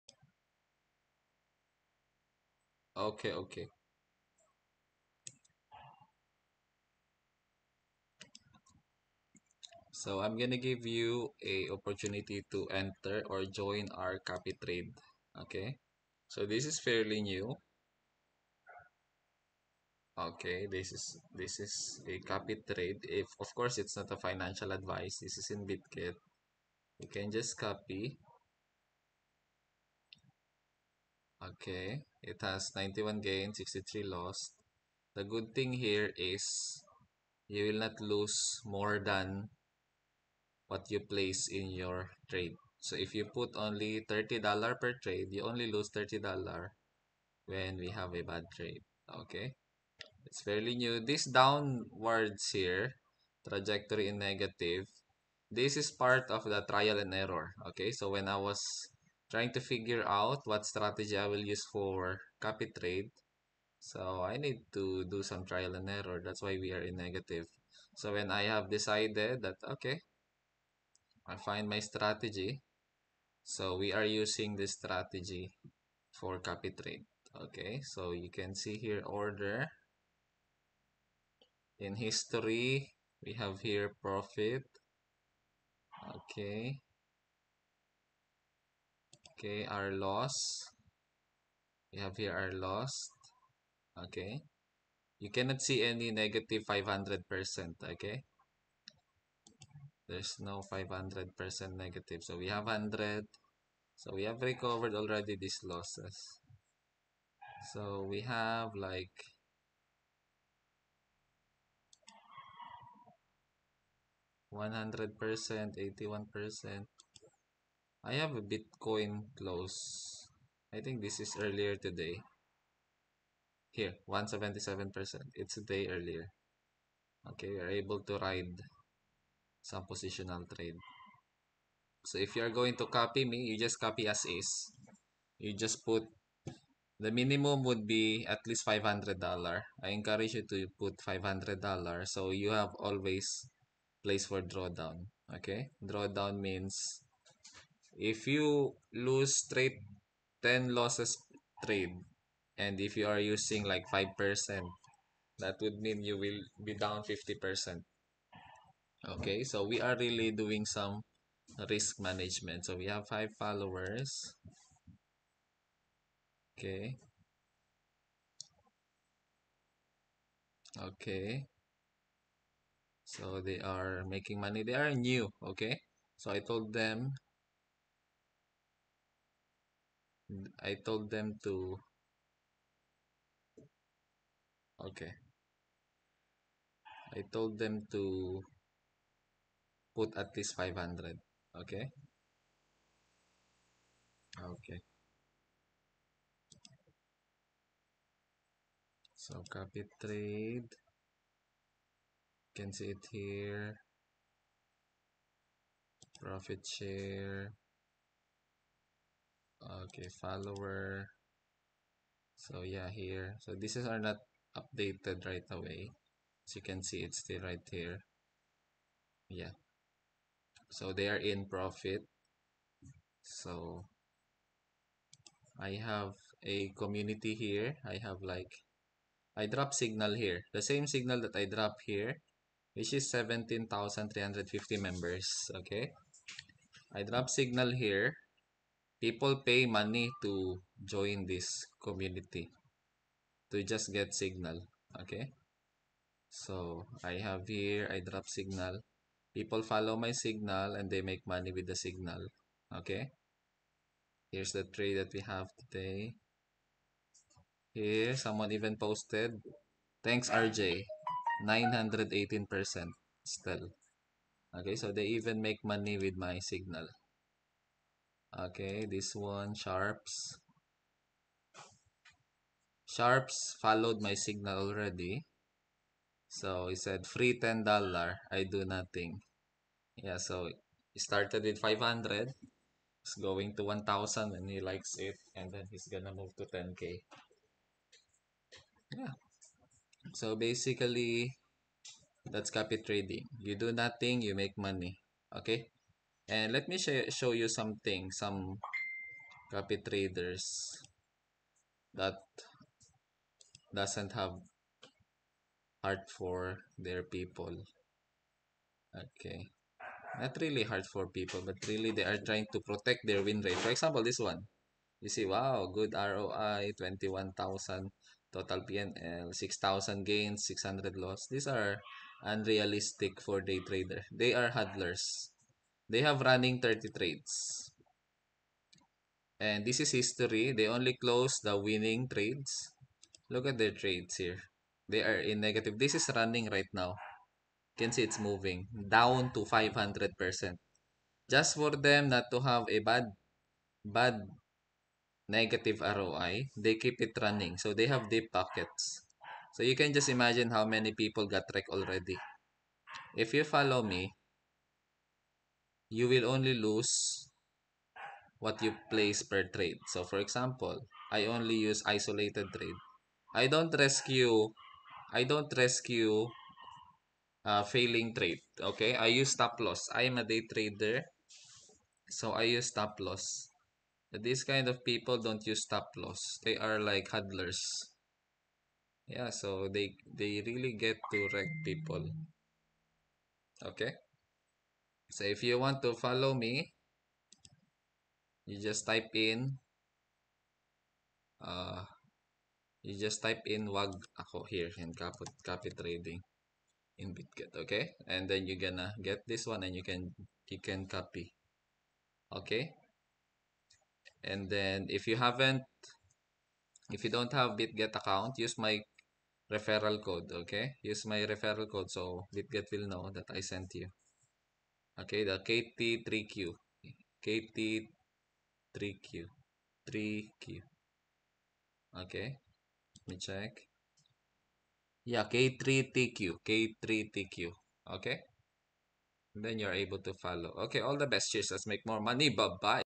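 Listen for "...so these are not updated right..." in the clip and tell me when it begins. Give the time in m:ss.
3:33.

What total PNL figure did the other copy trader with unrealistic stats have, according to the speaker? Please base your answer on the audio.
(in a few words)
21,000.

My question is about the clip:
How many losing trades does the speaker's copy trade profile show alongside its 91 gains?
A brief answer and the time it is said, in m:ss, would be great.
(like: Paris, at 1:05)
63, at 0:33.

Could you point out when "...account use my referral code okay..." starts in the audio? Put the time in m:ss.
6:47.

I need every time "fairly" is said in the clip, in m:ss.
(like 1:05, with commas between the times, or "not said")
0:16, 0:50.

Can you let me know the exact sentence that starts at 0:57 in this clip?
Okay, so when I was trying to figure out what strategy I will use for copy trade.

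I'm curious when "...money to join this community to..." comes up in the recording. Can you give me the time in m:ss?
3:59.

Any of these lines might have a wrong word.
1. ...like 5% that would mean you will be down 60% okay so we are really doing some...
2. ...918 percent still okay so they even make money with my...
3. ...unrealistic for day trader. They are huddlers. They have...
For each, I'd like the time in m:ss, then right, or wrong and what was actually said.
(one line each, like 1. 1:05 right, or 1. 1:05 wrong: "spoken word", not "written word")
1. 2:33 wrong: "50", not "60"
2. 4:21 right
3. 5:22 right.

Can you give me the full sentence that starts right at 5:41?
Just for them not to have a bad, bad negative ROI, they keep it running.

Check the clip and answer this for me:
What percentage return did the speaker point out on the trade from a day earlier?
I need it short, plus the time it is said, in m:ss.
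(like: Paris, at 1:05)
177%, at 2:04.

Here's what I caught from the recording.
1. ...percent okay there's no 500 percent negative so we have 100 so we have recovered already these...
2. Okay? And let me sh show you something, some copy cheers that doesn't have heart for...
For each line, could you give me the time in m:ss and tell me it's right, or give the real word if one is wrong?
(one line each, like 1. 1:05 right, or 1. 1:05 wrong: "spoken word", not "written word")
1. 1:37 right
2. 4:55 wrong: "traders", not "cheers".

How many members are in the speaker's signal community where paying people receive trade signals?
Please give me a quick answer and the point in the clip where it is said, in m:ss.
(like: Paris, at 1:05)
17,350, at 3:53.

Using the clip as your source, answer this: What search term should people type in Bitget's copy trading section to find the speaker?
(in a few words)
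wag ako.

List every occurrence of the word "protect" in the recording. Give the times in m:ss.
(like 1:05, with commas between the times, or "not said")
5:12.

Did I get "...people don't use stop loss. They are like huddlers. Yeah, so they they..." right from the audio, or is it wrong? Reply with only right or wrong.
right.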